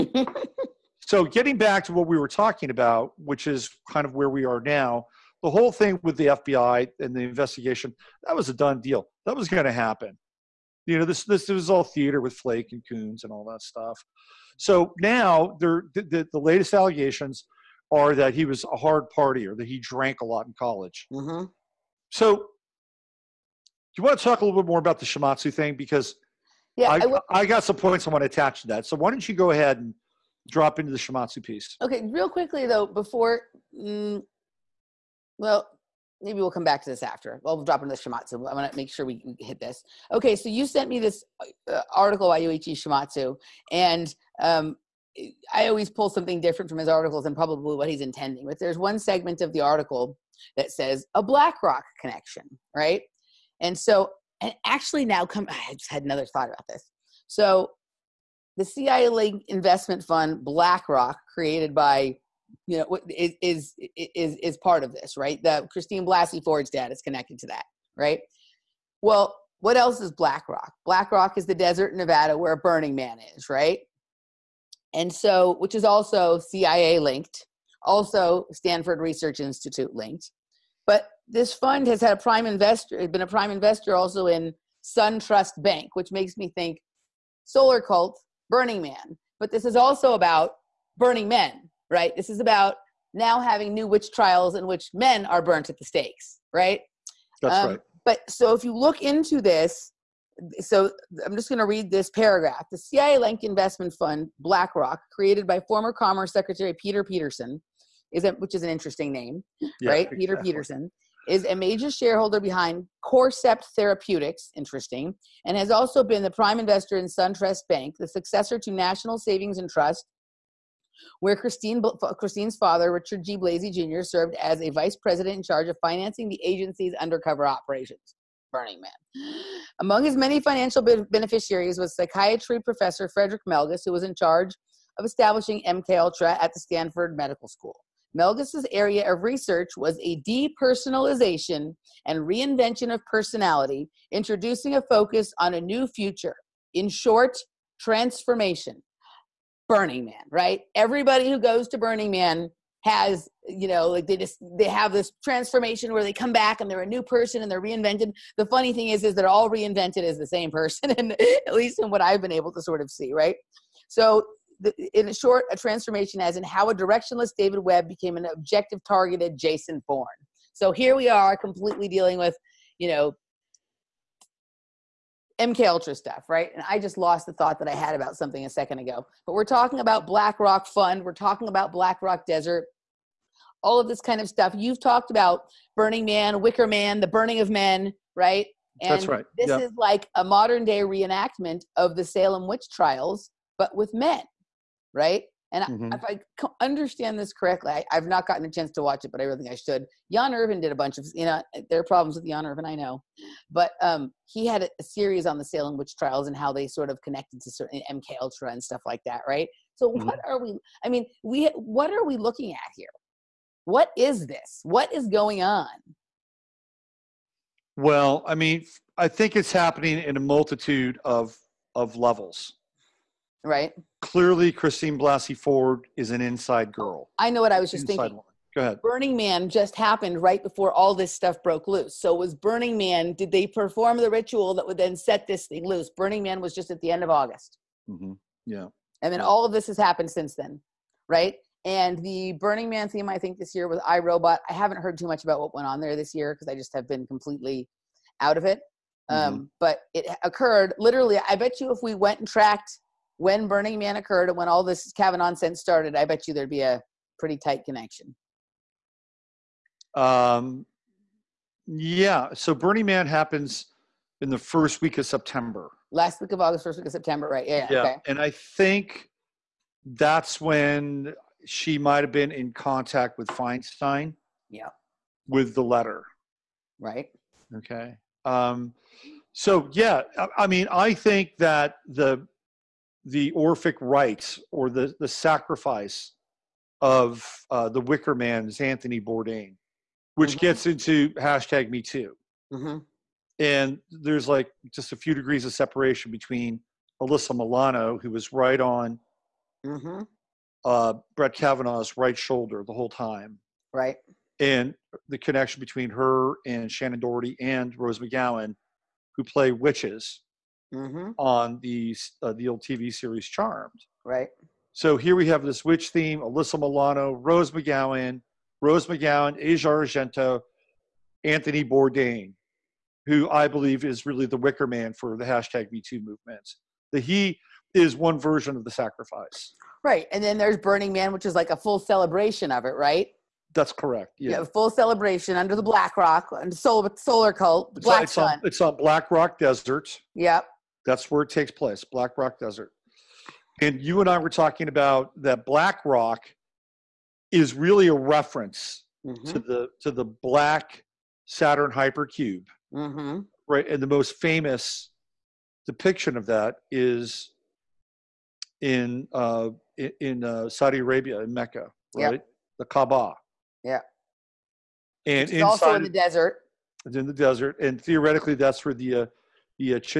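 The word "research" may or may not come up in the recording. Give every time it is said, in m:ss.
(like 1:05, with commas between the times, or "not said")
1:18, 2:19.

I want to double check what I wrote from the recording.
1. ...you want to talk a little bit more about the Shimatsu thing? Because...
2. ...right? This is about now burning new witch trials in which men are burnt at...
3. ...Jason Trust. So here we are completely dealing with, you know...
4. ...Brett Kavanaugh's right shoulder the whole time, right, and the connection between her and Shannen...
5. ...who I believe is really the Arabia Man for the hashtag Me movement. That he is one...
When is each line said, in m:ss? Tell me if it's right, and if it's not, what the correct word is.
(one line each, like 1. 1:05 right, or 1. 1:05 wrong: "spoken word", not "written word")
1. 0:23 right
2. 1:31 wrong: "having", not "burning"
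3. 2:49 wrong: "Bourne", not "Trust"
4. 5:01 right
5. 5:23 wrong: "Wicker", not "Arabia".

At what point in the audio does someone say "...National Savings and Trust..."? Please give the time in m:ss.
1:58.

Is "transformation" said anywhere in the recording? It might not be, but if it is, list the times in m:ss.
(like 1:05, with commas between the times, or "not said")
2:27, 2:35, 2:45.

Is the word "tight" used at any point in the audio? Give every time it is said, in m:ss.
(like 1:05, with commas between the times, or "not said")
4:17.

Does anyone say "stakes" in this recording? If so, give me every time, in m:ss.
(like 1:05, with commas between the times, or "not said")
1:35.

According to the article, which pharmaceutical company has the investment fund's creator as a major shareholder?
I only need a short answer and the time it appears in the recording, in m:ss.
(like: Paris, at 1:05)
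Corcept Therapeutics, at 1:53.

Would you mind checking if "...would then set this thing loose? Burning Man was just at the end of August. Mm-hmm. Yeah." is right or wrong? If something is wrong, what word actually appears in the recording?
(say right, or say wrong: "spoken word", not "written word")
right.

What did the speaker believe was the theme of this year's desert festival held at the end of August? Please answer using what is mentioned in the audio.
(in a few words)
iRobot.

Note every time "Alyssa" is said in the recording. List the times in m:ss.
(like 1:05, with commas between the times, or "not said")
4:57, 5:16.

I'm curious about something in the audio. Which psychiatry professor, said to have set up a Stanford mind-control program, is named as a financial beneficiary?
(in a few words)
Frederick Melges.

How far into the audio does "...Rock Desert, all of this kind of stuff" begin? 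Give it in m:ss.
3:02.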